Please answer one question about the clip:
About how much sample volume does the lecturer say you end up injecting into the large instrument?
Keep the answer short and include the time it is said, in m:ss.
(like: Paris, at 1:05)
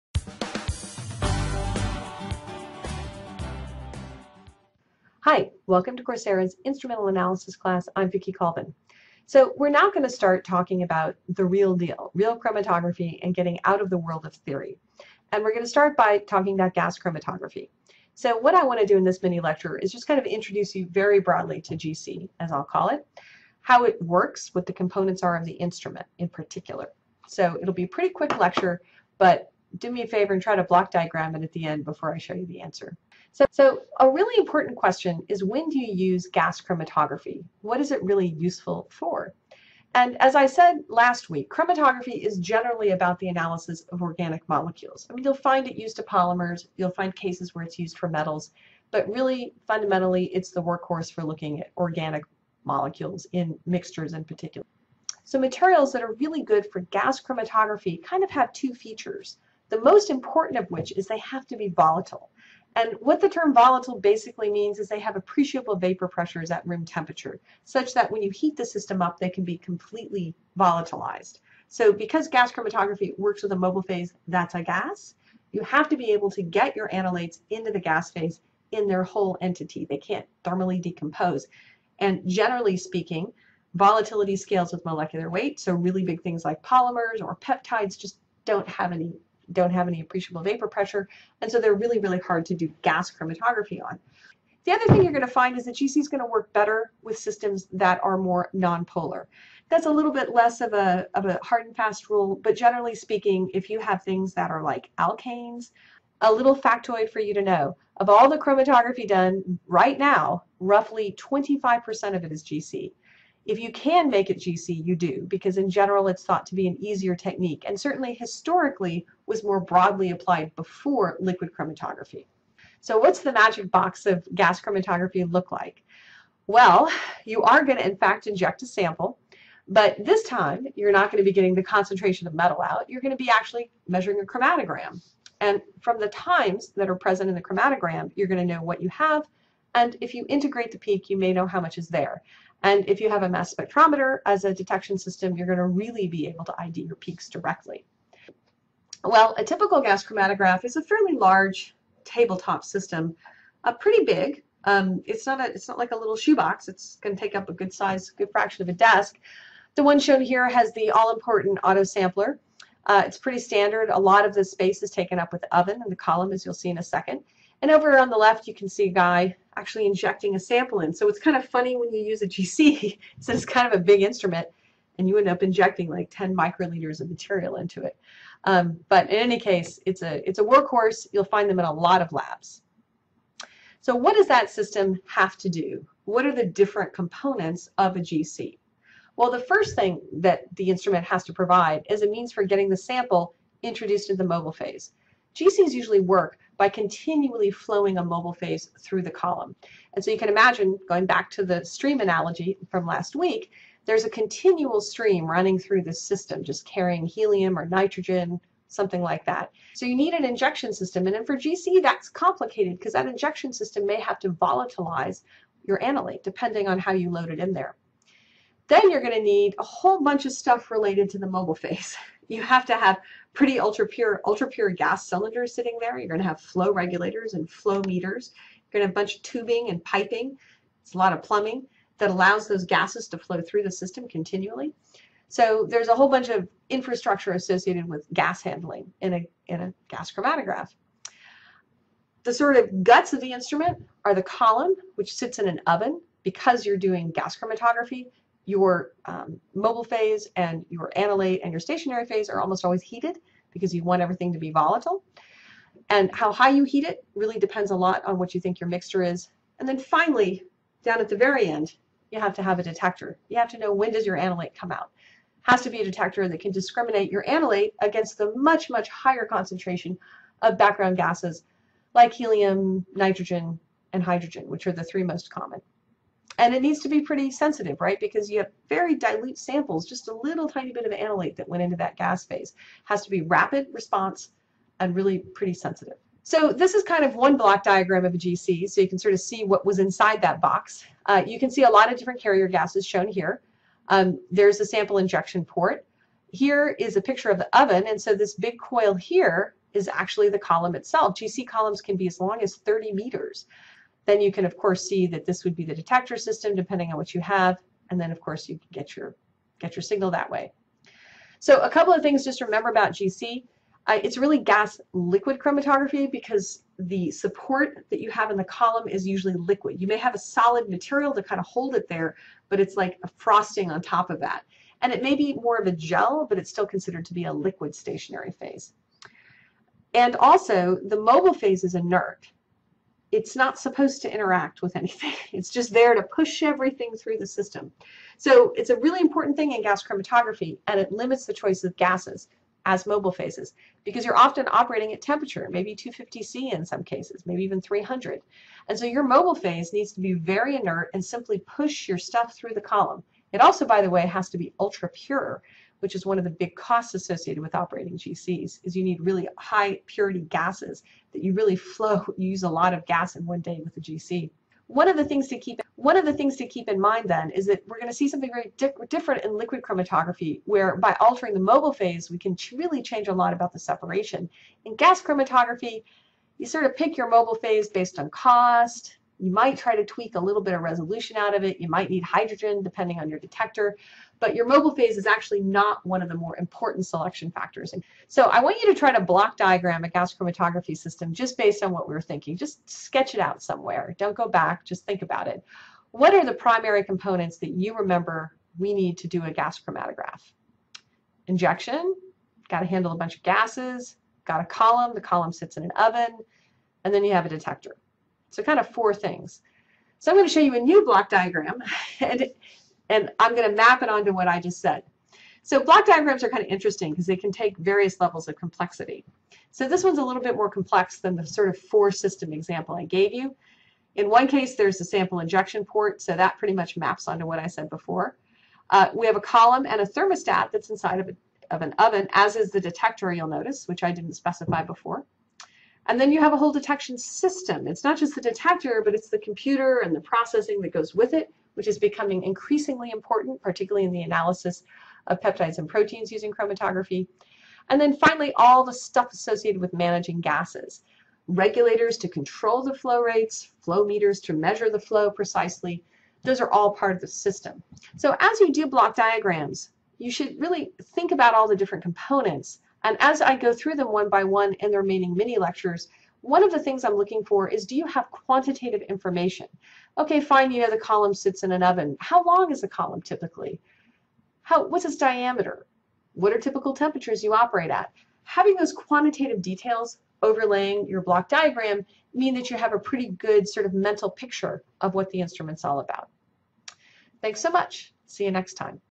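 10 microliters, at 2:56.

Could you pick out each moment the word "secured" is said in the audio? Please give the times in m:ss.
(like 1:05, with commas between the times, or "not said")
not said.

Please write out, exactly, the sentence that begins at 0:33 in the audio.
So, so a really important question is when do you use gas chromatography?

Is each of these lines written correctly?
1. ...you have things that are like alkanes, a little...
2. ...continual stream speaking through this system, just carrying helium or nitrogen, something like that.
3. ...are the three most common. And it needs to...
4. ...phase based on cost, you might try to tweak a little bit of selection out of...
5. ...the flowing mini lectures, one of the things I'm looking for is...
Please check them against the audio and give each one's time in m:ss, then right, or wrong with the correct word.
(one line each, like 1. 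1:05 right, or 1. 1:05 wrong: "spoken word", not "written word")
1. 1:43 right
2. 3:24 wrong: "running", not "speaking"
3. 4:34 right
4. 6:17 wrong: "resolution", not "selection"
5. 7:44 wrong: "remaining", not "flowing".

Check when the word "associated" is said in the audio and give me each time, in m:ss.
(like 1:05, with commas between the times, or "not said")
3:57, 5:56, 7:29.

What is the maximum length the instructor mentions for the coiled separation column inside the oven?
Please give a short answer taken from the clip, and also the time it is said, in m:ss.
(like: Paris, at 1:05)
30 meters, at 5:02.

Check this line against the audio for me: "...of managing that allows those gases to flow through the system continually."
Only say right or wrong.
wrong.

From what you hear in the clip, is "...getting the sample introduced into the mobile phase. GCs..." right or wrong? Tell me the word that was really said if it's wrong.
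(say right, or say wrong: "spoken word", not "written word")
right.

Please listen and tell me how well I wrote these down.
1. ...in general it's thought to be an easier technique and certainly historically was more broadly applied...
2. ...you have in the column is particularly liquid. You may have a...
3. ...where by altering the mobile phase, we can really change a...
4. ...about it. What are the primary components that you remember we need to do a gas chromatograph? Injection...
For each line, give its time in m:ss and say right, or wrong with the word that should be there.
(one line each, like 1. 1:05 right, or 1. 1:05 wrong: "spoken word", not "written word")
1. 1:55 right
2. 5:17 wrong: "usually", not "particularly"
3. 6:10 right
4. 6:35 right.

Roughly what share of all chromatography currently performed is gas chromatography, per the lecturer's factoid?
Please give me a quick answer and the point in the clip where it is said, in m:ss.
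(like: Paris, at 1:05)
25%, at 1:51.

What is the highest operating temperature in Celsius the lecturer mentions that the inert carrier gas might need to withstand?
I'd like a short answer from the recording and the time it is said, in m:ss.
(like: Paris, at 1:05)
300, at 5:47.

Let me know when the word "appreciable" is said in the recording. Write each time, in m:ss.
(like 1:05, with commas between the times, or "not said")
1:05, 1:30.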